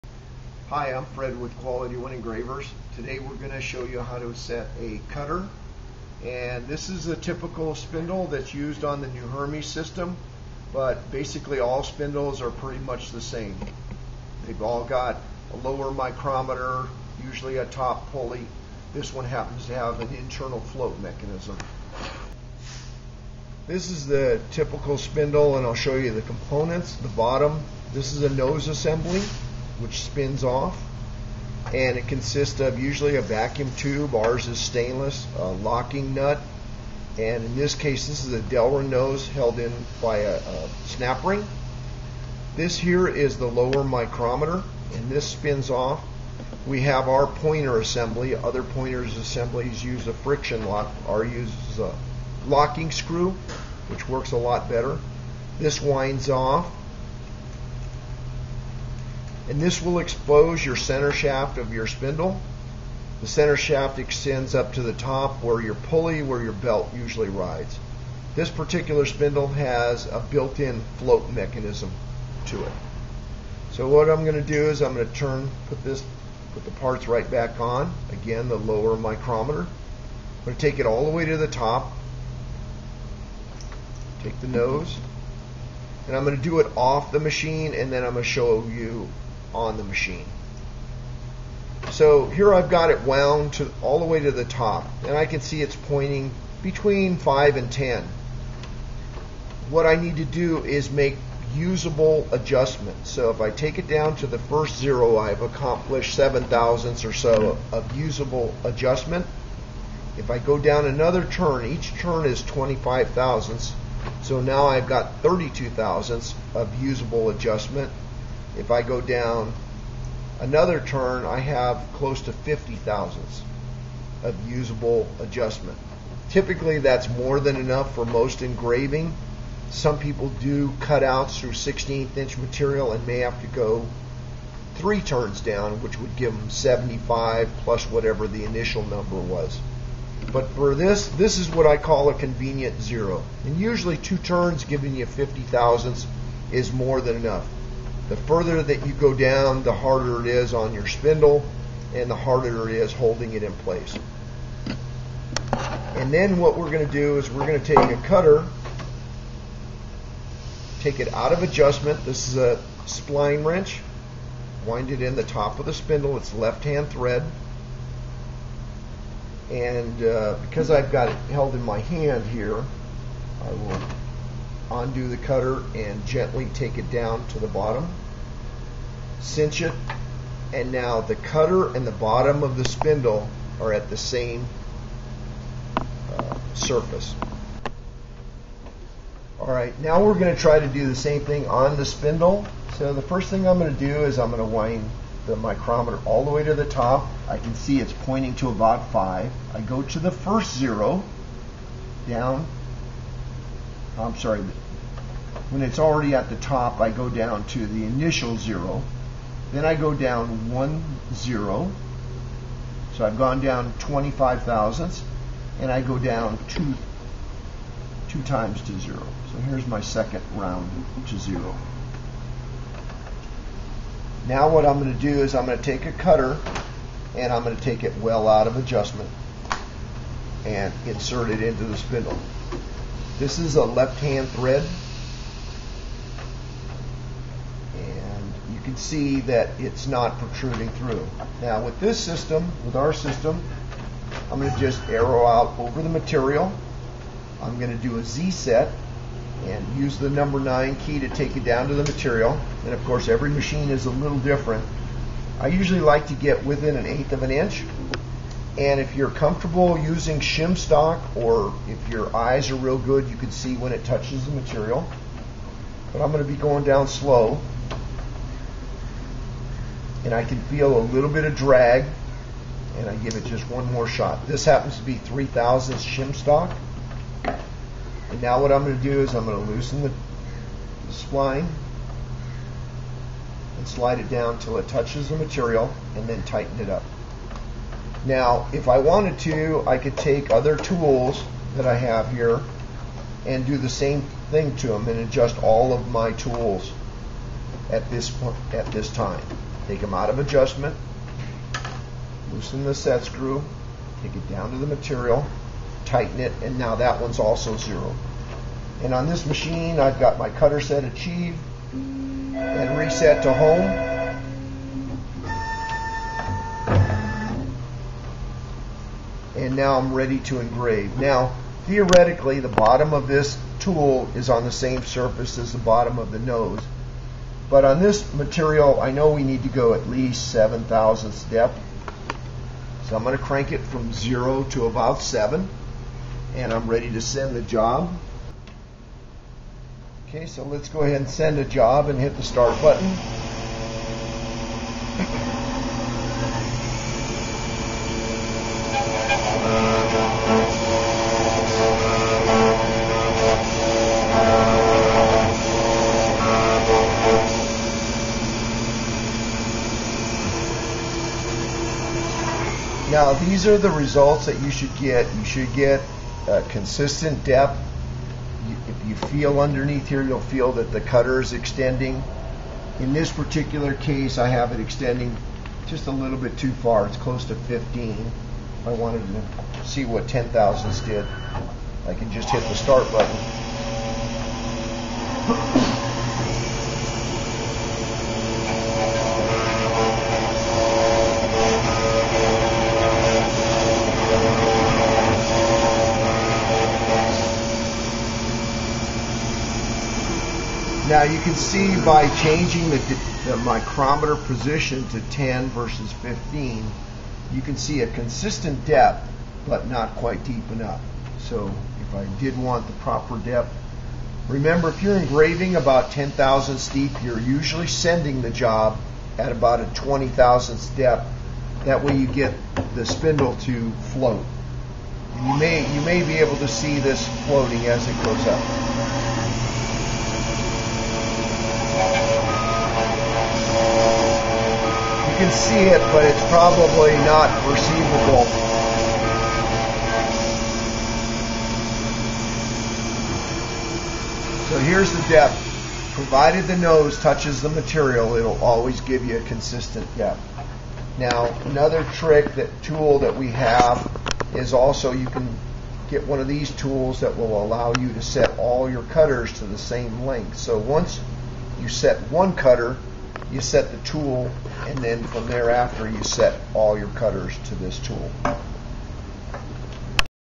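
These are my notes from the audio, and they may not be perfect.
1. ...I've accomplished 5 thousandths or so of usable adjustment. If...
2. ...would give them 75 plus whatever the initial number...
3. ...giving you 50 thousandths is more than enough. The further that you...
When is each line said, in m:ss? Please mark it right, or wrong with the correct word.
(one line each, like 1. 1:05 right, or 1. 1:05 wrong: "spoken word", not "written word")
1. 1:45 wrong: "7", not "5"
2. 2:15 right
3. 2:24 right.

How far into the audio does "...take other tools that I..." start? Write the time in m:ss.
4:49.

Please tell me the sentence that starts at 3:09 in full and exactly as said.
Alright, now we're going to try to do the same thing on the spindle.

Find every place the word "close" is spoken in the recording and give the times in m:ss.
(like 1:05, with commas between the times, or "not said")
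2:01, 6:16.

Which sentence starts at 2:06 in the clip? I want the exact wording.
Typically, that's more than enough for most engraving.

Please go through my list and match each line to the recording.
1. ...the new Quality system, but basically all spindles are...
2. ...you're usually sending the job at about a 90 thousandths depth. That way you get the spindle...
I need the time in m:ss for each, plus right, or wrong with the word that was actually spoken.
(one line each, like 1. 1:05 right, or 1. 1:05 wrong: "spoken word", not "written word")
1. 0:09 wrong: "Hermes", not "Quality"
2. 6:57 wrong: "20", not "90".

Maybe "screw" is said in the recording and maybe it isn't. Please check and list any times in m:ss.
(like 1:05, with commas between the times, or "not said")
0:52, 5:03.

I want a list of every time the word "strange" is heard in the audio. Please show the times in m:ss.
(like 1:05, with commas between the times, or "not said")
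not said.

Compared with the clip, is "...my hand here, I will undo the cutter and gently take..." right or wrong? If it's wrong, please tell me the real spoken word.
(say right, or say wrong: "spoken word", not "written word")
right.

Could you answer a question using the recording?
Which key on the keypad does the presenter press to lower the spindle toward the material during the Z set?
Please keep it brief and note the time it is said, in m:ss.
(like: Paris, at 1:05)
number 9, at 4:10.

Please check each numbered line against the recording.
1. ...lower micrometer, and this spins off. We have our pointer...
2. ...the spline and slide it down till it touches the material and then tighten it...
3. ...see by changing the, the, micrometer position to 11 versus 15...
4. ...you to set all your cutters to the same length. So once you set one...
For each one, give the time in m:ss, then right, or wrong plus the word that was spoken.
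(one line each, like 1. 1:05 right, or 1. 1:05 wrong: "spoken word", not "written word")
1. 0:43 right
2. 4:39 right
3. 6:41 wrong: "10", not "11"
4. 7:37 right.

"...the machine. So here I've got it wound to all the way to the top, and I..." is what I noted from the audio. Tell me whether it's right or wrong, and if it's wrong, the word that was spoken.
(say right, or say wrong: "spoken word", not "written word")
right.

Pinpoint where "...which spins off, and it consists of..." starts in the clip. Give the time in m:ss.
0:29.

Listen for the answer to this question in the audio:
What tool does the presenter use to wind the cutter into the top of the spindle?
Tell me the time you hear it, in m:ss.
2:42.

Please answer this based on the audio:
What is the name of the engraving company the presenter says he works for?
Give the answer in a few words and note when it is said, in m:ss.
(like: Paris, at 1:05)
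Quality One Engravers, at 0:01.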